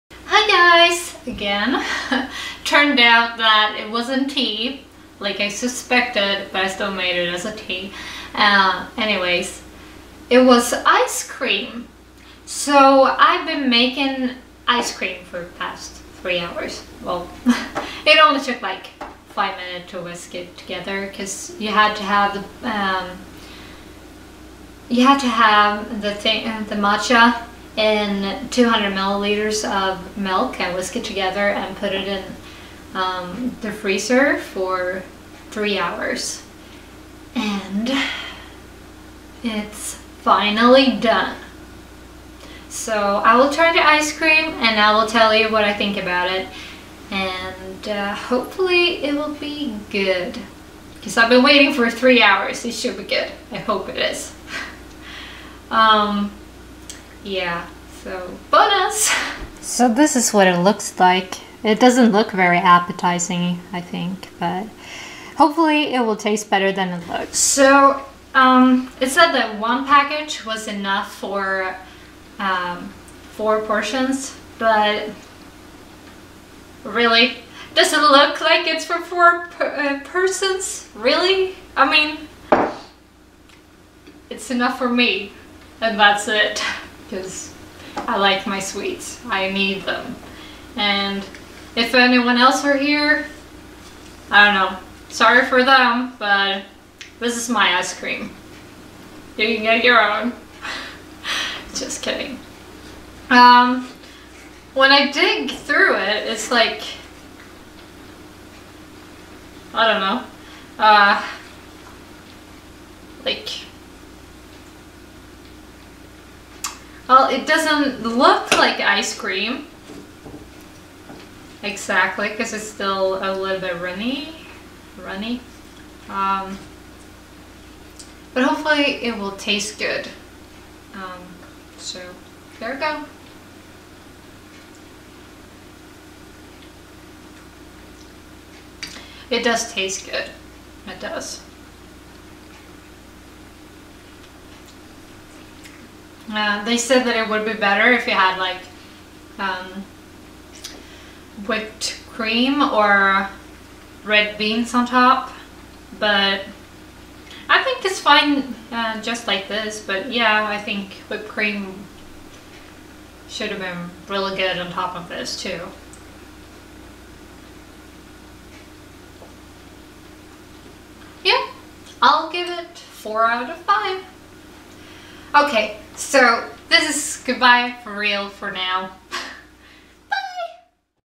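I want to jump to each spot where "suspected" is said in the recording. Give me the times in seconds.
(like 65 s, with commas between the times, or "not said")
5 s.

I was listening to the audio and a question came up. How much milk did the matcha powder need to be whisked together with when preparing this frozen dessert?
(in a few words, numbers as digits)
200 milliliters.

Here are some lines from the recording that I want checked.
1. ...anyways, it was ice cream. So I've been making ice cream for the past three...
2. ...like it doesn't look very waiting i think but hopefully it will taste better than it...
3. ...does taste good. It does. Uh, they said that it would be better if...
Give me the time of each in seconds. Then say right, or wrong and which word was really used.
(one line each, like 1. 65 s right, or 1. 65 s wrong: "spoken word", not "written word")
1. 8 s right
2. 60 s wrong: "appetizing", not "waiting"
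3. 139 s right.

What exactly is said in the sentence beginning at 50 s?
Because I've been waiting for three hours.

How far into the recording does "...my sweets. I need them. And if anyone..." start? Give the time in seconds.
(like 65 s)
88 s.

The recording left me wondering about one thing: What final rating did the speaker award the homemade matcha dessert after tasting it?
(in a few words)
4 out of 5.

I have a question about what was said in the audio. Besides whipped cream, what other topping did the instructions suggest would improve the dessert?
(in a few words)
red beans.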